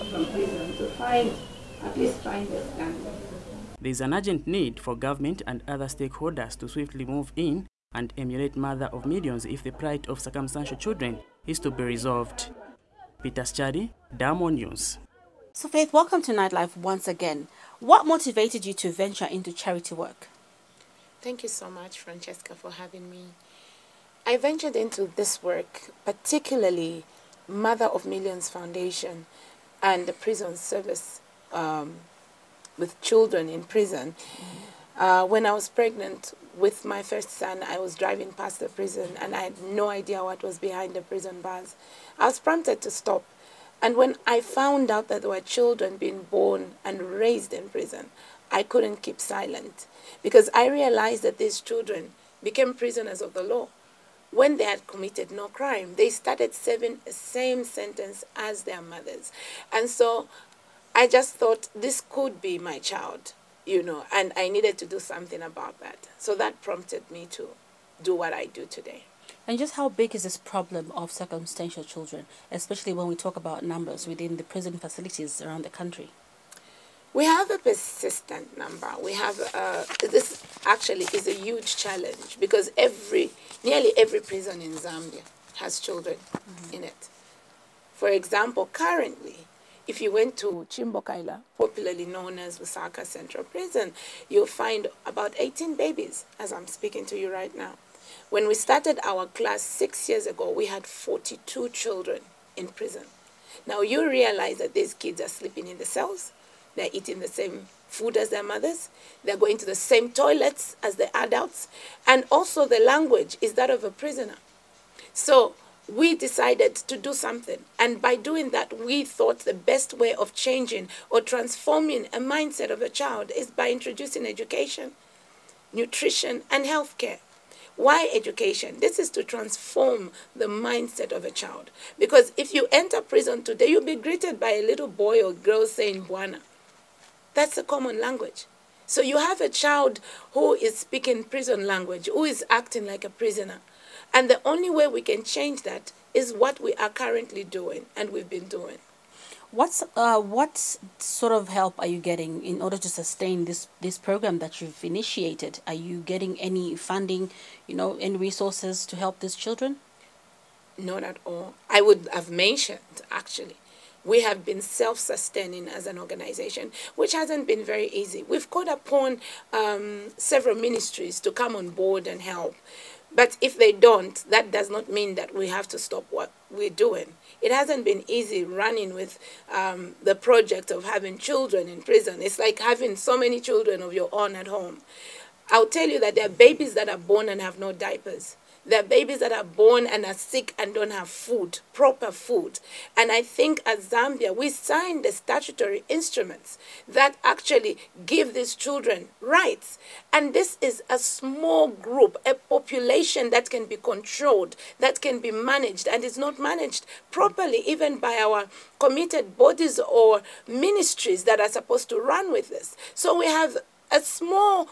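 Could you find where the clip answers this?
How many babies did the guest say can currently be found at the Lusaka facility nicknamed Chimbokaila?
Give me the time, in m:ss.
1:35.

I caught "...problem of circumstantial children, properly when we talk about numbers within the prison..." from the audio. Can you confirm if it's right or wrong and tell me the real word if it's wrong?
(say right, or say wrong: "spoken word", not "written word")
wrong: "especially", not "properly".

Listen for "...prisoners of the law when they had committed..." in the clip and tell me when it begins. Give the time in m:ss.
0:52.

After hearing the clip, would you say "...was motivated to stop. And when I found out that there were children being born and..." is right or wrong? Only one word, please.
wrong.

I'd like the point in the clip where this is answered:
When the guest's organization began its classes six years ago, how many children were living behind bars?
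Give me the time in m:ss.
1:40.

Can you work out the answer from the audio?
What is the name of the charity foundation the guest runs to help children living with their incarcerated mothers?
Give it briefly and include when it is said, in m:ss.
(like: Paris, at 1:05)
Mother of Millions Foundation, at 0:27.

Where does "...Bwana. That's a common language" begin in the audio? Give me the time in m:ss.
2:16.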